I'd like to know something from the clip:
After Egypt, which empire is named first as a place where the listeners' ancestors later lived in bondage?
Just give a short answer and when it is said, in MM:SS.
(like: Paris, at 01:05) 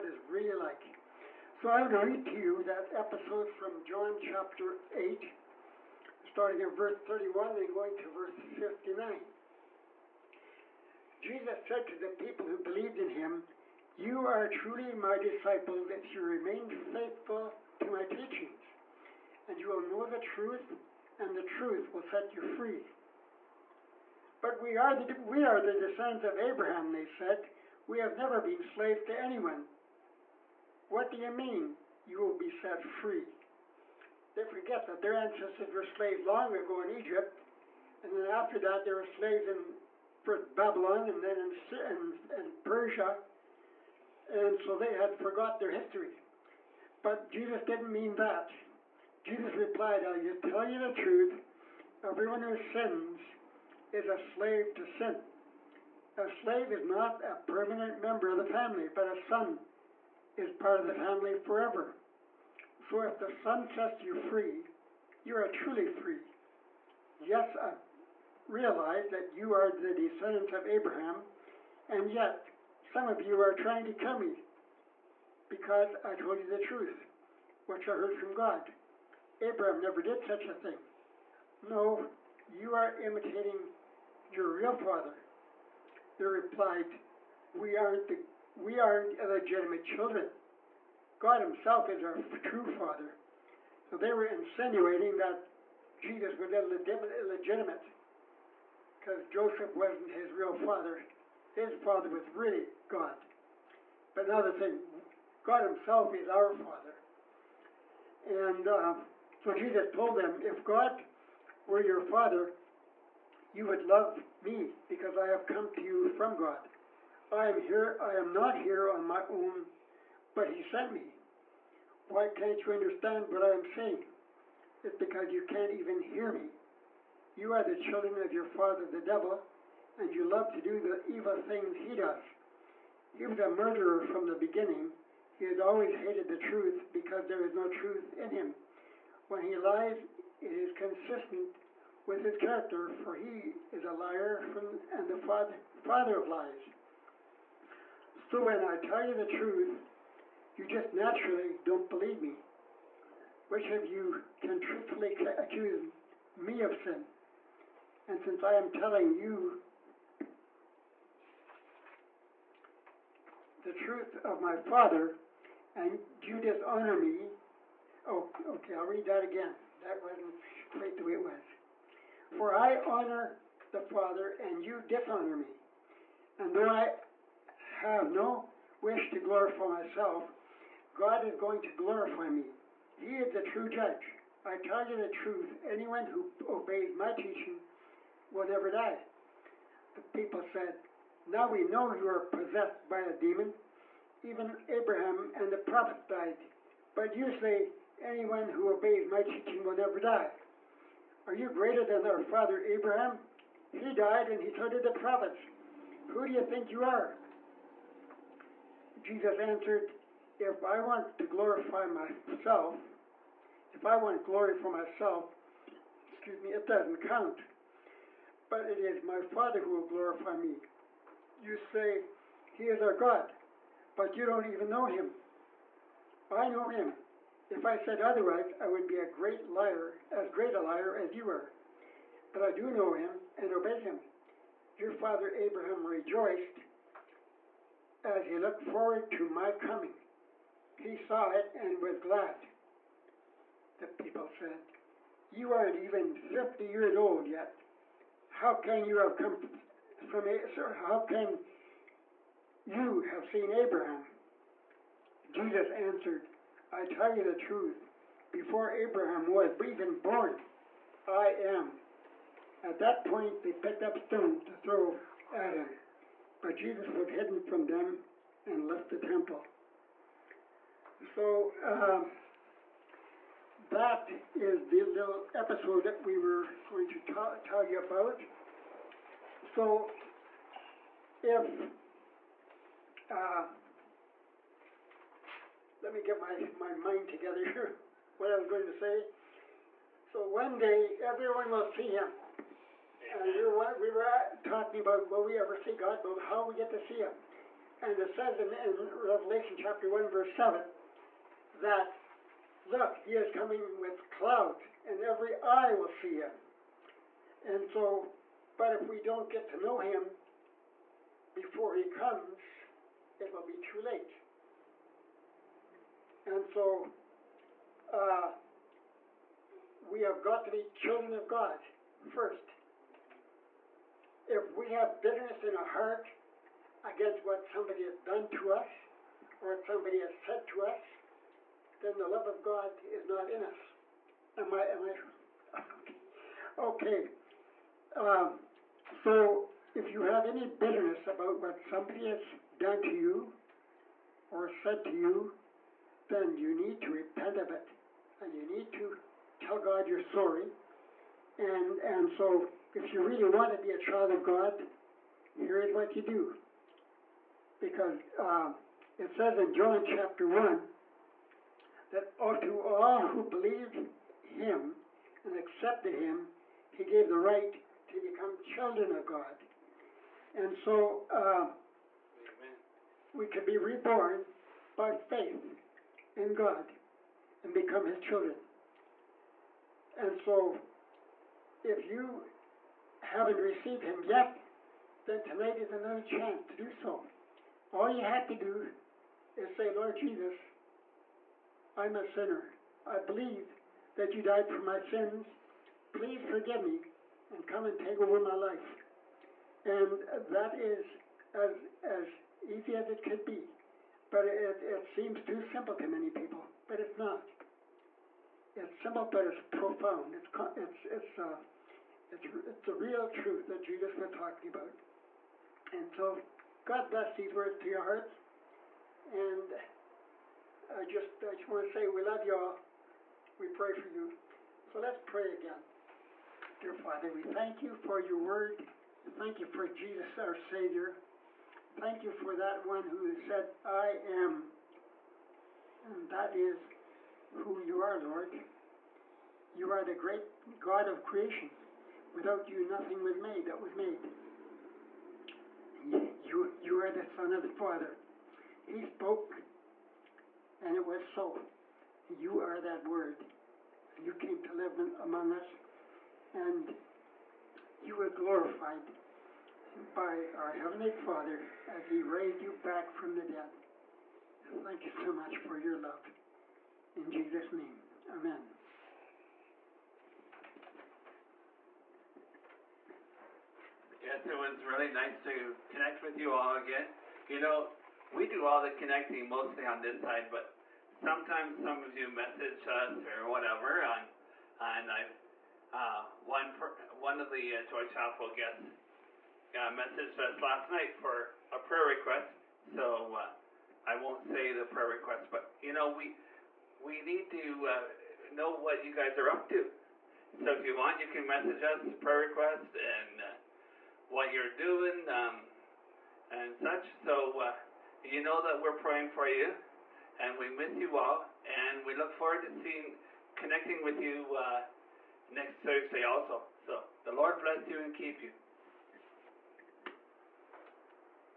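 Babylon, at 00:40.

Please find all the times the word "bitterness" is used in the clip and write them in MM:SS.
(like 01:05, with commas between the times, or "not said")
05:25, 05:40.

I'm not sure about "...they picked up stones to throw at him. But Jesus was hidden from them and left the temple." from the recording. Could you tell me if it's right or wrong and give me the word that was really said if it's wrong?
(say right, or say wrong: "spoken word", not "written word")
right.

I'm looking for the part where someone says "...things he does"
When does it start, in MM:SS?
02:11.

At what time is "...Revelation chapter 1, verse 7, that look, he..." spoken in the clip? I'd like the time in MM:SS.
04:59.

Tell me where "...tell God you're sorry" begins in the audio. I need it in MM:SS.
05:49.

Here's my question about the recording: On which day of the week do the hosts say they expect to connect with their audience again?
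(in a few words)
Thursday.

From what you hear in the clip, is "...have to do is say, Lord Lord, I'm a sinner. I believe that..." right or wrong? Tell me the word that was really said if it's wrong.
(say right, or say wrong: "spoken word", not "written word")
wrong: "Jesus", not "Lord".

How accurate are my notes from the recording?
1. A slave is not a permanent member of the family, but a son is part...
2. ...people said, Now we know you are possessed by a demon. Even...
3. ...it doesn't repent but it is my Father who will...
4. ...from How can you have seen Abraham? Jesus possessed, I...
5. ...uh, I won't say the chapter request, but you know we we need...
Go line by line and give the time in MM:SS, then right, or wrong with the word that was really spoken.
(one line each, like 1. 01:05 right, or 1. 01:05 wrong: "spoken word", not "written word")
1. 00:56 right
2. 03:10 right
3. 03:36 wrong: "count", not "repent"
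4. 04:10 wrong: "answered", not "possessed"
5. 08:13 wrong: "prayer", not "chapter".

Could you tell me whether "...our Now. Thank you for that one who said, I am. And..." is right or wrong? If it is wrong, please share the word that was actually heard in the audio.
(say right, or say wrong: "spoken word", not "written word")
wrong: "Savior", not "Now".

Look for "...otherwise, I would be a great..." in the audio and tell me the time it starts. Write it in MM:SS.
03:48.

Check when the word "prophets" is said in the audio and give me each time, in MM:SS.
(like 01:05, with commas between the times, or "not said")
03:15, 03:24.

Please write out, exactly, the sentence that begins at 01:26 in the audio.
They replied, we aren't, the, we aren't illegitimate children.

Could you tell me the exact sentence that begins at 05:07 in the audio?
And so, but if we don't get to know him before he comes, it will be too late.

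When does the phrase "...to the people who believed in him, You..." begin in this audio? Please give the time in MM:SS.
00:11.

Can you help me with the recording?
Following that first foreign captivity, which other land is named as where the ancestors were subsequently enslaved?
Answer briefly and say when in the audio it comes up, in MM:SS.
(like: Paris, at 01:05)
Persia, at 00:42.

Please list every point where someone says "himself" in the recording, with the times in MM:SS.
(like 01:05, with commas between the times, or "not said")
01:31, 01:45.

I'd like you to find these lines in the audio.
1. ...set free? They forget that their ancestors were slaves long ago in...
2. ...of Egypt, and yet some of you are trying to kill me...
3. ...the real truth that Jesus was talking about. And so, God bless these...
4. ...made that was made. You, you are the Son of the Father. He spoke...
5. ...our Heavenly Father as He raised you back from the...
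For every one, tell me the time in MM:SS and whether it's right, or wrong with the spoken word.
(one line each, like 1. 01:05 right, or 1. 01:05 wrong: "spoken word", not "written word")
1. 00:32 right
2. 01:10 wrong: "Abraham", not "Egypt"
3. 06:52 right
4. 07:23 right
5. 07:40 right.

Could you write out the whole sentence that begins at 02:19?
When he lies, it is consistent with his character, for he is a liar from, and the father, father of lies.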